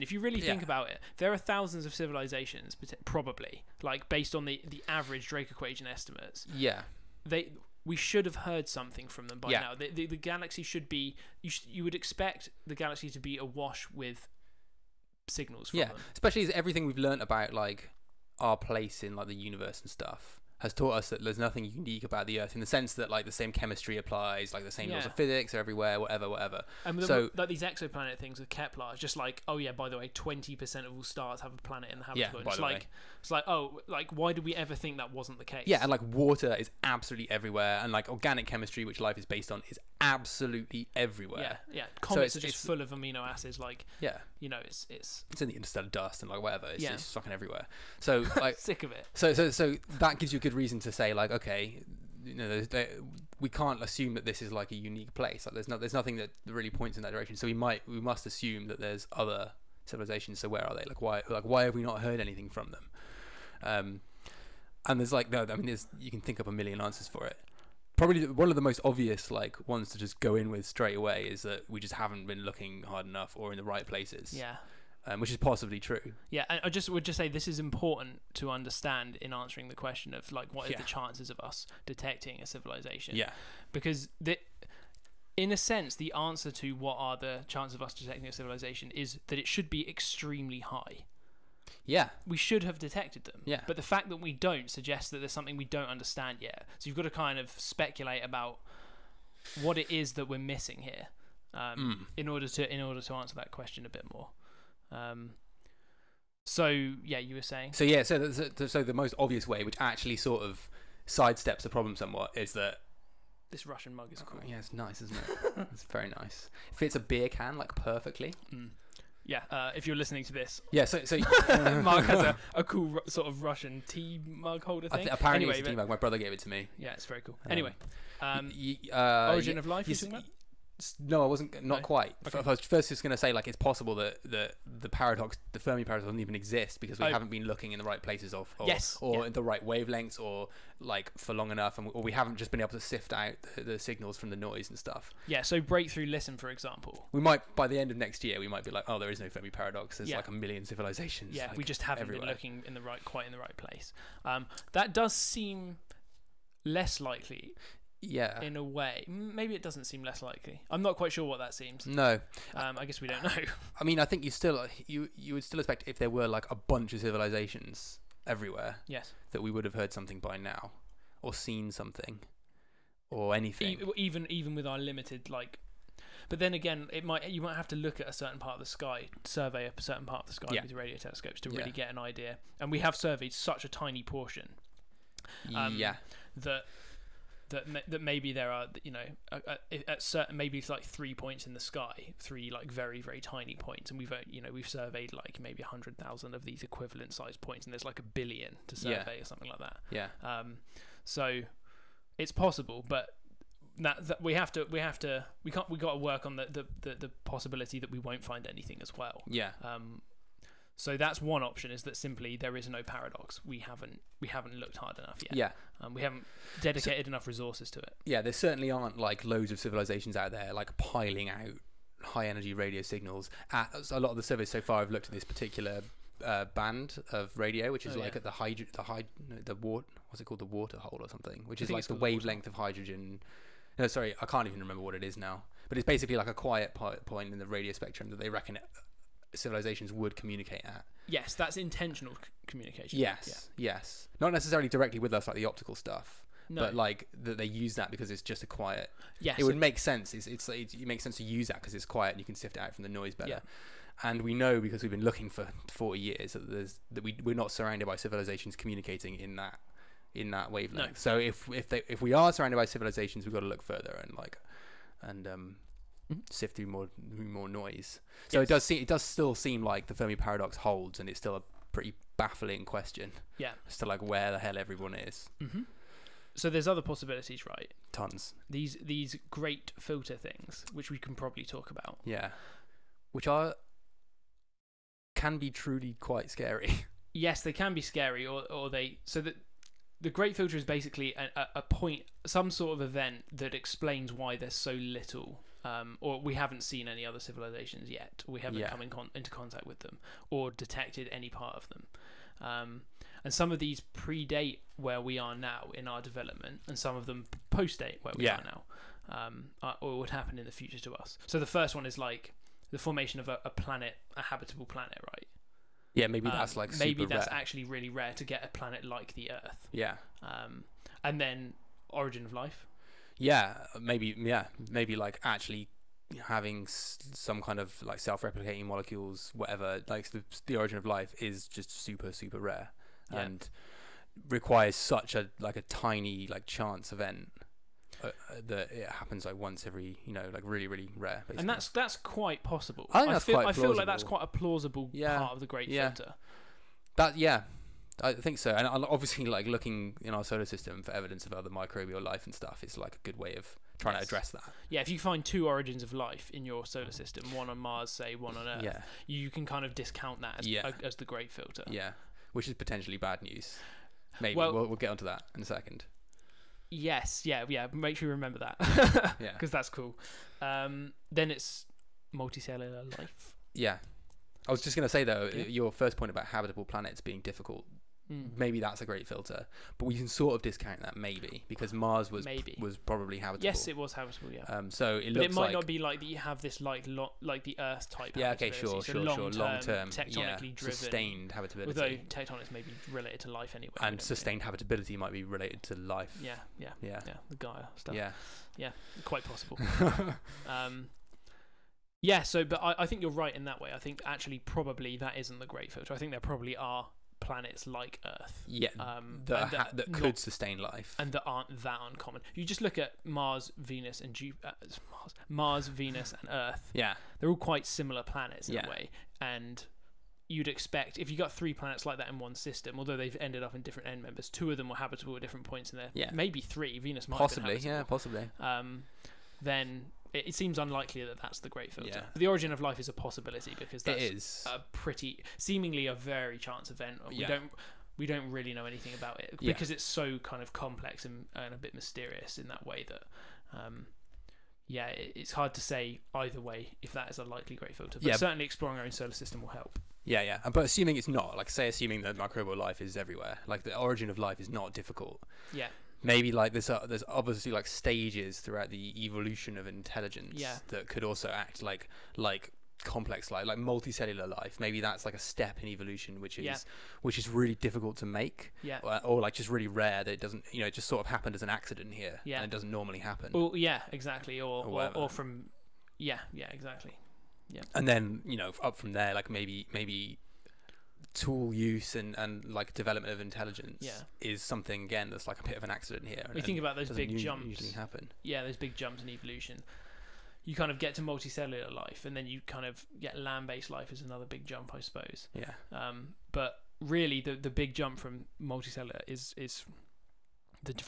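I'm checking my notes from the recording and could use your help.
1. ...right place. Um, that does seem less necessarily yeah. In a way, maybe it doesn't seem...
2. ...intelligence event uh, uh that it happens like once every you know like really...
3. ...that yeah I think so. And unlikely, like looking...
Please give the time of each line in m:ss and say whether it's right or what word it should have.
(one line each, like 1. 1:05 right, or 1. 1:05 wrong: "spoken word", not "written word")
1. 2:33 wrong: "likely", not "necessarily"
2. 5:36 wrong: "chance", not "intelligence"
3. 5:46 wrong: "obviously", not "unlikely".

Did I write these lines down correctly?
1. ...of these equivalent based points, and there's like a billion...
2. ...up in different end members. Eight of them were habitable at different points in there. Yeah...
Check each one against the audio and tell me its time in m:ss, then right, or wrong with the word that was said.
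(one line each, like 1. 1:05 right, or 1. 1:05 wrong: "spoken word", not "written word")
1. 3:16 wrong: "sized", not "based"
2. 7:03 wrong: "Two", not "Eight".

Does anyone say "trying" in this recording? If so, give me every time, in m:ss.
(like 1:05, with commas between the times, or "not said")
5:53.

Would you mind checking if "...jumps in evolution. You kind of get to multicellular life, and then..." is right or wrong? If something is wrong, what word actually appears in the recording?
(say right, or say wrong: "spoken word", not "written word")
right.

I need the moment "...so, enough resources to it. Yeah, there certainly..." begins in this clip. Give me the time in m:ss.
3:37.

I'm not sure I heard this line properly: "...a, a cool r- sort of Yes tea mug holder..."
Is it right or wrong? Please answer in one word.
wrong.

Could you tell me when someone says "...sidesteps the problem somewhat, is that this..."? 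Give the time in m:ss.
1:51.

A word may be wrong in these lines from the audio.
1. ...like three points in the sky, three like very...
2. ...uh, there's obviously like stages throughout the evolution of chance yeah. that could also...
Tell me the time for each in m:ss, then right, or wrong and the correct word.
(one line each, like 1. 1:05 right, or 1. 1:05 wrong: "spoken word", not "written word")
1. 3:10 right
2. 7:36 wrong: "intelligence", not "chance".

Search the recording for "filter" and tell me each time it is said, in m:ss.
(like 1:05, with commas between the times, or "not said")
4:39, 4:50, 5:45, 6:01, 6:19, 6:45, 7:11, 7:27.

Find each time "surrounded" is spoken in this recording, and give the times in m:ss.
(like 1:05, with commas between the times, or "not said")
4:17, 4:22.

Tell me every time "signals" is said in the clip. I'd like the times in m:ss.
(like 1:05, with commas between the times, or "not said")
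0:15, 2:23, 3:42.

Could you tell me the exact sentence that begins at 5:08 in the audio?
are now, um, or would happen in the future to us.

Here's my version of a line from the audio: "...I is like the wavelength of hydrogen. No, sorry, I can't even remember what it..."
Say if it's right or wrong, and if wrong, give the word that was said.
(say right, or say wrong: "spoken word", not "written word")
right.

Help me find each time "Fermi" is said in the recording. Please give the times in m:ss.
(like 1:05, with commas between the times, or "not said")
2:15, 2:29, 4:29.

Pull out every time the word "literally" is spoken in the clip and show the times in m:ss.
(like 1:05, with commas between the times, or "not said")
not said.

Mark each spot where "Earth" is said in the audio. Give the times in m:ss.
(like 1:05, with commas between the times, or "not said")
0:22, 5:19, 5:58, 6:27, 6:48, 6:56.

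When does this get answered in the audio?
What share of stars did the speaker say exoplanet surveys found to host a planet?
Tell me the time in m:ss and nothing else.
0:30.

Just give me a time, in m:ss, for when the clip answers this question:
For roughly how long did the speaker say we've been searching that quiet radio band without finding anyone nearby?
4:15.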